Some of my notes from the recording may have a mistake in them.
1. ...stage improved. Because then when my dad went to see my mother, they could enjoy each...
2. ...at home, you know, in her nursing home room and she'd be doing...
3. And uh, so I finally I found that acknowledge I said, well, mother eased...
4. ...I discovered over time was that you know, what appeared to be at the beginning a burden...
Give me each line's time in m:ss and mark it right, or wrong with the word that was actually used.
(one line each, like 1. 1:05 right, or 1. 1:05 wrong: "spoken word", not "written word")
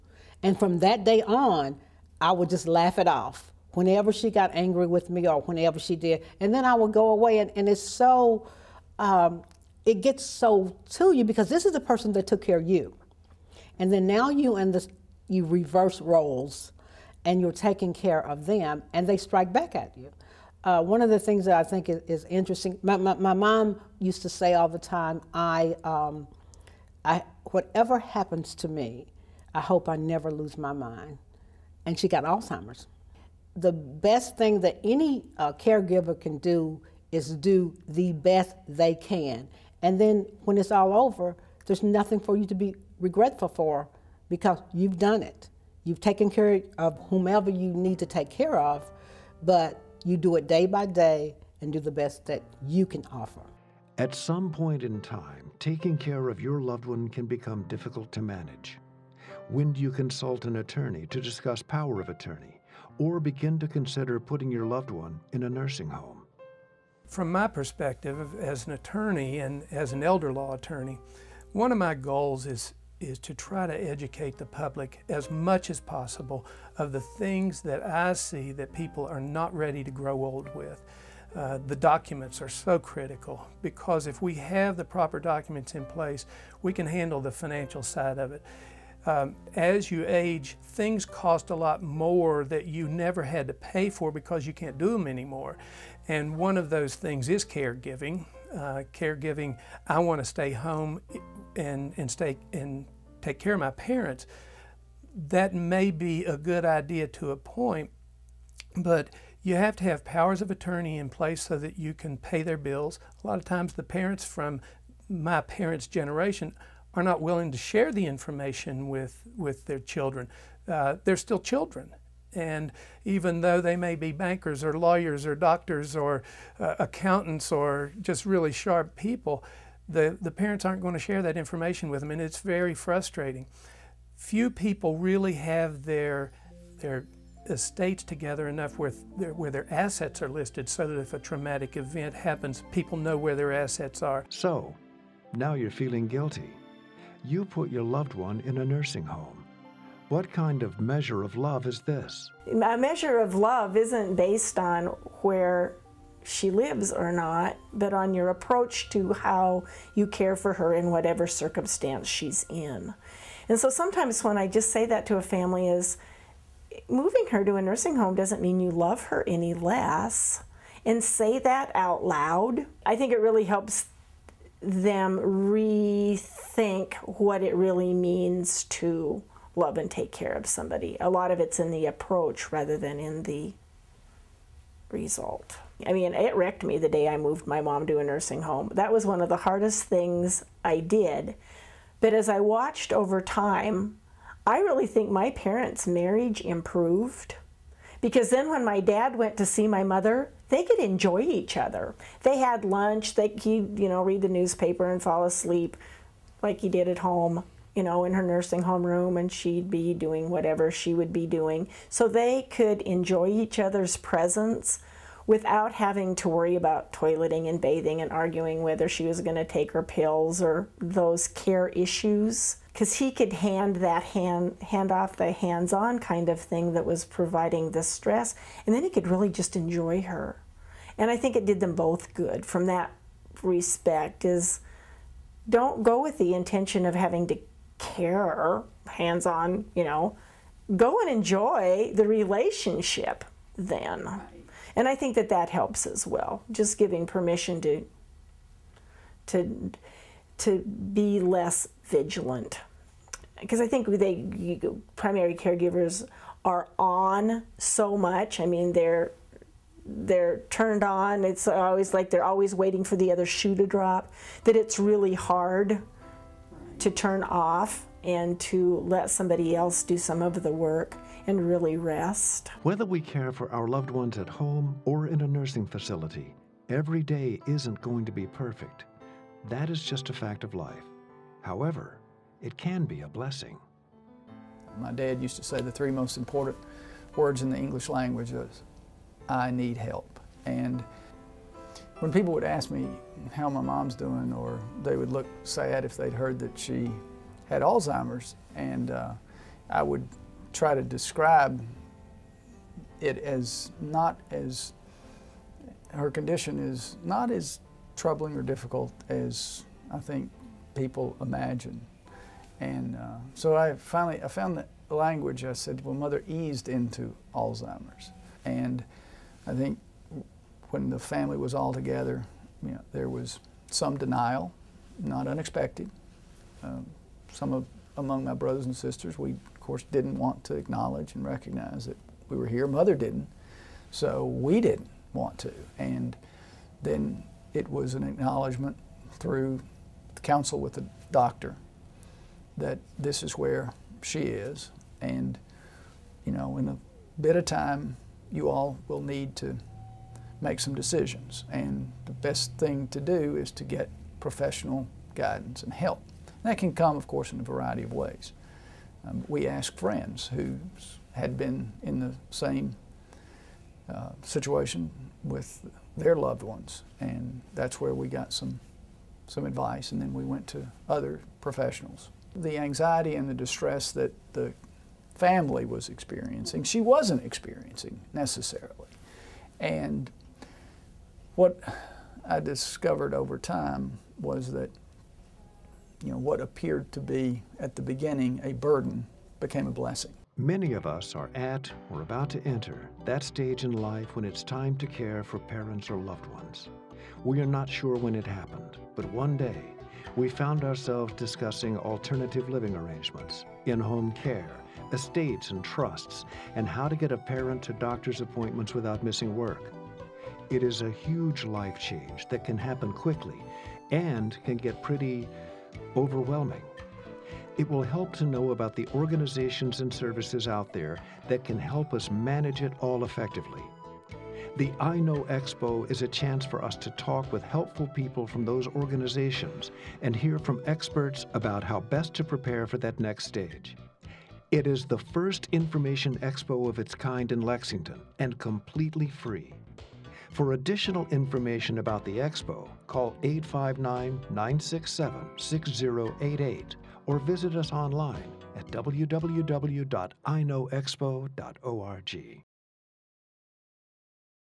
1. 3:15 wrong: "marriage", not "stage"
2. 3:26 right
3. 5:12 wrong: "language", not "acknowledge"
4. 6:22 right.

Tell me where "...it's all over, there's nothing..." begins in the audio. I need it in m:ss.
0:40.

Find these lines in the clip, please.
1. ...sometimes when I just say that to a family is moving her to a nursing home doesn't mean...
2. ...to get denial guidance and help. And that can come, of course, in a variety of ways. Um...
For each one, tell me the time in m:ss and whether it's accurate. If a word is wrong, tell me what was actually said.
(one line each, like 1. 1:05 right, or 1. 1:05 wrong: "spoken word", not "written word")
1. 2:43 right
2. 5:53 wrong: "professional", not "denial".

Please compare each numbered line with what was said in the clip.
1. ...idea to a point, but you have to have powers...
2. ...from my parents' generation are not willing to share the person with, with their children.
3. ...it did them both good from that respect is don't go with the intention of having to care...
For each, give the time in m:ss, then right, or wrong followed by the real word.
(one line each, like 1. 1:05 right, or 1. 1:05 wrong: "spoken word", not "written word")
1. 1:46 right
2. 1:54 wrong: "information", not "person"
3. 3:51 right.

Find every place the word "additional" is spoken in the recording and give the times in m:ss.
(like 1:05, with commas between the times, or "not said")
7:20.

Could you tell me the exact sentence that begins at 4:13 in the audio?
Because I think they, primary caregivers are on so much.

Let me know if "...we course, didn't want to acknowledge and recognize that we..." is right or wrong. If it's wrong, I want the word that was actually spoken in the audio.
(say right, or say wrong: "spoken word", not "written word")
right.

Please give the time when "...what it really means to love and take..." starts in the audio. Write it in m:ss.
2:57.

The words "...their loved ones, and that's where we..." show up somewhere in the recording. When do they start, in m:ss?
6:05.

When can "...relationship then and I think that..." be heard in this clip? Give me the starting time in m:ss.
4:02.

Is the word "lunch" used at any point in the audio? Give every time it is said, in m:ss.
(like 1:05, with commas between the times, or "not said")
3:22.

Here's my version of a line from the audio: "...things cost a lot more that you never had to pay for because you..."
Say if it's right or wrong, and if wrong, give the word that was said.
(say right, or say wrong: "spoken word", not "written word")
right.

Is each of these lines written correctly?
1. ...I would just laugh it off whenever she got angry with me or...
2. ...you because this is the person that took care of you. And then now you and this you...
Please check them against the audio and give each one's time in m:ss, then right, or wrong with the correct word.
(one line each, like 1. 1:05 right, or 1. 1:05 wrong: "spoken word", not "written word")
1. 0:02 right
2. 0:11 right.